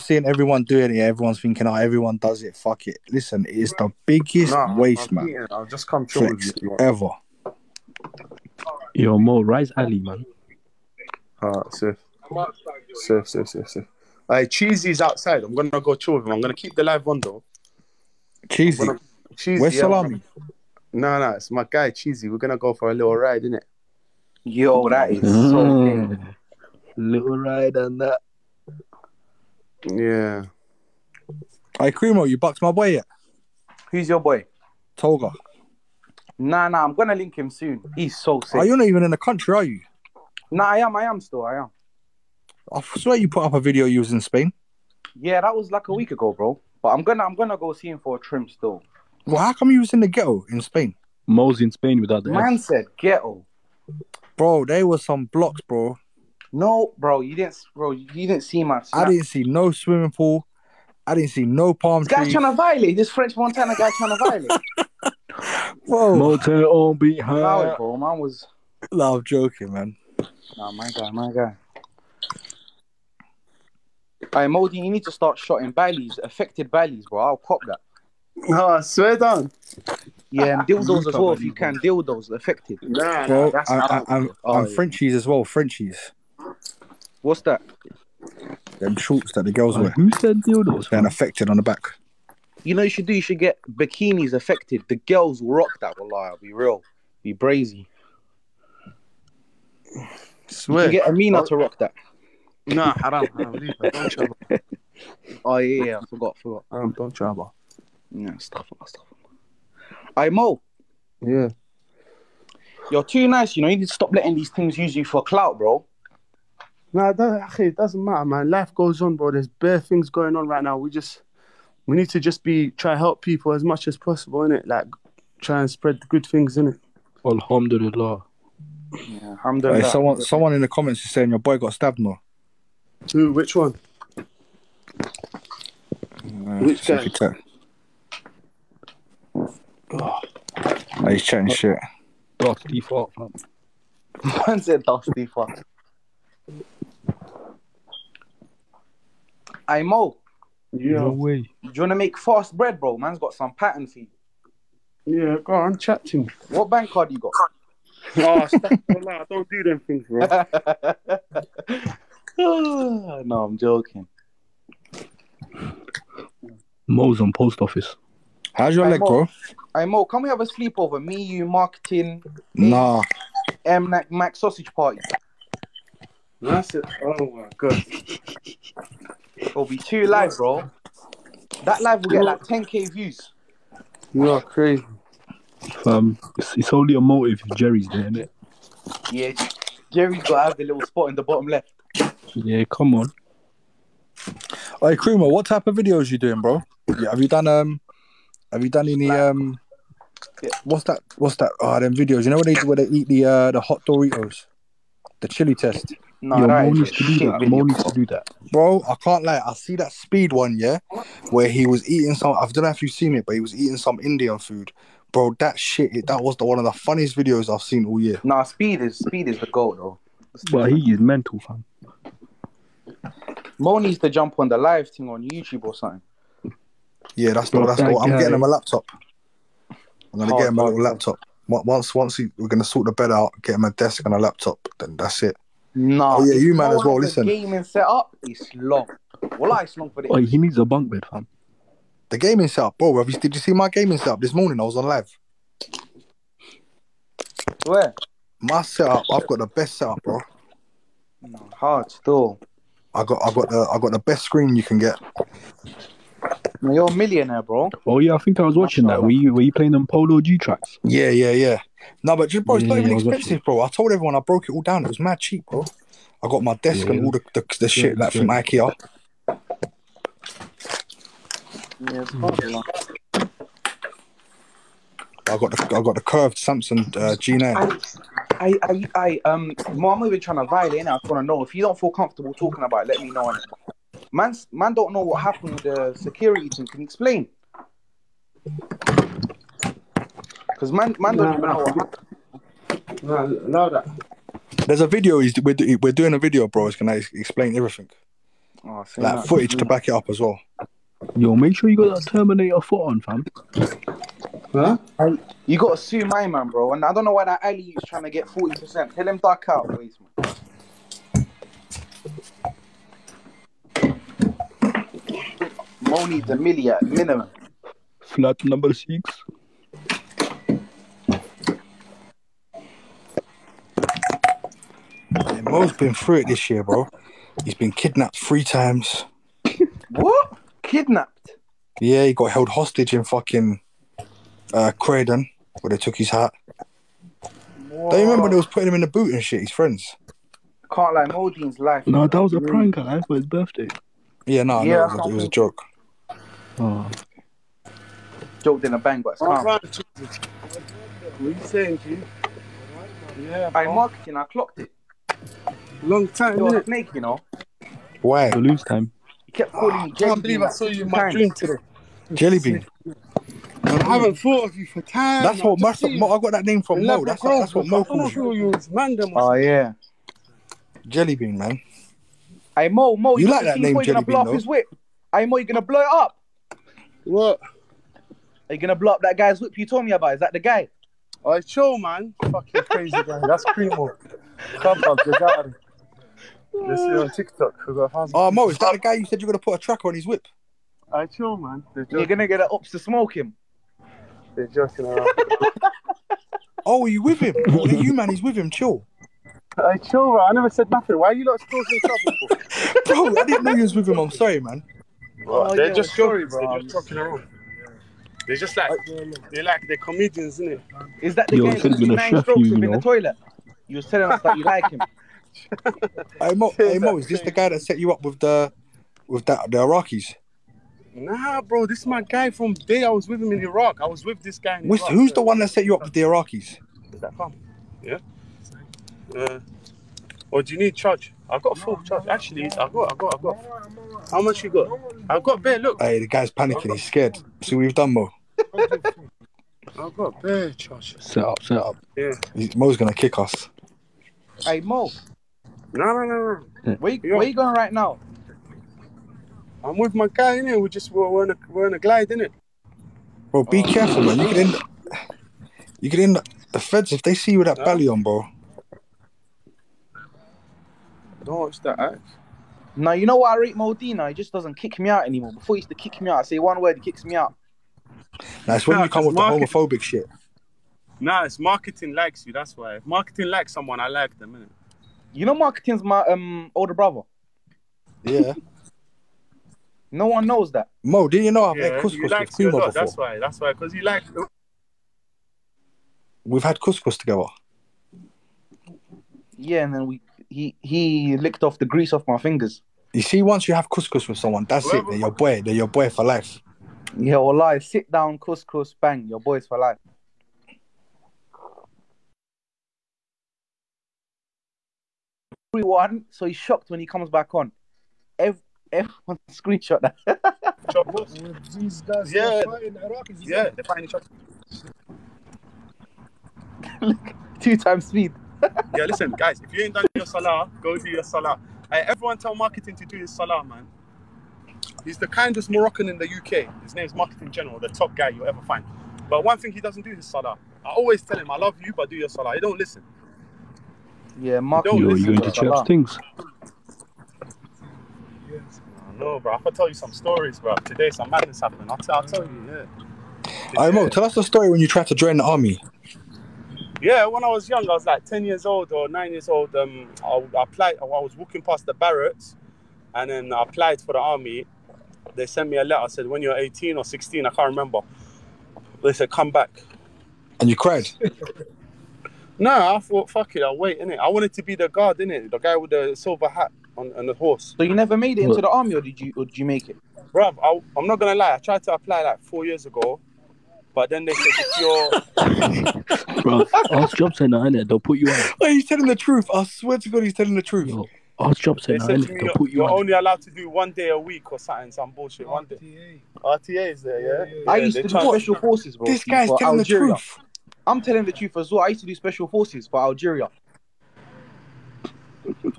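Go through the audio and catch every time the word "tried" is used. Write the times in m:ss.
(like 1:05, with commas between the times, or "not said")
9:04, 9:31, 9:47.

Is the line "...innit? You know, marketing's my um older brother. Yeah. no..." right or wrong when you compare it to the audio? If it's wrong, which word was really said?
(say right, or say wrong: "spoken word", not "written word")
right.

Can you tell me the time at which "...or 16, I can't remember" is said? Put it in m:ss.
9:16.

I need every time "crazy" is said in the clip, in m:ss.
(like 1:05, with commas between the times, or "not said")
3:04, 6:22.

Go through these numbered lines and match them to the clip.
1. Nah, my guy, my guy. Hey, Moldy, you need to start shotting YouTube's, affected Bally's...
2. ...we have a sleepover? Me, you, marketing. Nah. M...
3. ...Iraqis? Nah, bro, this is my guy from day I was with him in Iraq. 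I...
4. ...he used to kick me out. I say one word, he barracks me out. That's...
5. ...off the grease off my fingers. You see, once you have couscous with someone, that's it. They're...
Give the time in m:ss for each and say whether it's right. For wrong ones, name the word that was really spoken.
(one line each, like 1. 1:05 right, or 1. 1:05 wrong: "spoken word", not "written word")
1. 1:10 wrong: "Bally", not "YouTube"
2. 2:50 right
3. 6:59 right
4. 7:45 wrong: "kicks", not "barracks"
5. 8:11 right.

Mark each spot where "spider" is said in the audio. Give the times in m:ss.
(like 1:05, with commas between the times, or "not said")
not said.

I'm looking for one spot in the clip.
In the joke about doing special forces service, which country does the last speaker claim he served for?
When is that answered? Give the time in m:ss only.
9:52.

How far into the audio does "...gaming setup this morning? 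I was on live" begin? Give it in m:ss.
4:03.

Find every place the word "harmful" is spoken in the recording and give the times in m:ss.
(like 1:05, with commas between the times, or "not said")
not said.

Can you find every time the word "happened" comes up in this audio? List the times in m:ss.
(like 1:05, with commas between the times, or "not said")
4:45, 9:01.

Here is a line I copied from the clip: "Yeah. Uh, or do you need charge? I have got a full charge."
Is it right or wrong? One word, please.
right.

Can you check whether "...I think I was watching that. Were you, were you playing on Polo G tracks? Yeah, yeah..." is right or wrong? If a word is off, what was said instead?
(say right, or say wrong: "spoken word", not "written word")
right.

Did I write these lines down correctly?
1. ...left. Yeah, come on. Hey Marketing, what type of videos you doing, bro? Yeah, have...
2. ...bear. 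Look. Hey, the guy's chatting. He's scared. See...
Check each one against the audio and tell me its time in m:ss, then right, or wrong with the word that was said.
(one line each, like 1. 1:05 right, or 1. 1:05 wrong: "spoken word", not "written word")
1. 3:11 wrong: "Kruma", not "Marketing"
2. 7:15 wrong: "panicking", not "chatting".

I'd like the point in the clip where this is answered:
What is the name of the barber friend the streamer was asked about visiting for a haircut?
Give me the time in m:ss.
0:34.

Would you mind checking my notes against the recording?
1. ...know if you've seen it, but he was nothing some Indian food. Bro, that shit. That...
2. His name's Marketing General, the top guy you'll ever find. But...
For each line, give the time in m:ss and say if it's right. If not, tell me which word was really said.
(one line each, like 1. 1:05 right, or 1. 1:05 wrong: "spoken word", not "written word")
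1. 3:32 wrong: "eating", not "nothing"
2. 8:46 right.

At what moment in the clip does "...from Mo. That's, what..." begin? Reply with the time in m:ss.
6:06.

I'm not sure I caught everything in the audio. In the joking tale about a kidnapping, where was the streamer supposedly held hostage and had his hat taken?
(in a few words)
Croydon.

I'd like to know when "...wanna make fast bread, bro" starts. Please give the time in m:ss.
2:31.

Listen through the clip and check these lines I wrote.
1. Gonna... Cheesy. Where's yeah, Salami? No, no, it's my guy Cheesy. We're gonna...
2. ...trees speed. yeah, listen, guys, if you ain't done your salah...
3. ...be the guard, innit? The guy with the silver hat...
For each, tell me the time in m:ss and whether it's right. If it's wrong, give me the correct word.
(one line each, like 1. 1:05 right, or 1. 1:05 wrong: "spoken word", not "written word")
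1. 0:18 right
2. 8:37 wrong: "times", not "trees"
3. 9:24 right.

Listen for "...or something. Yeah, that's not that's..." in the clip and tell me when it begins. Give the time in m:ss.
3:45.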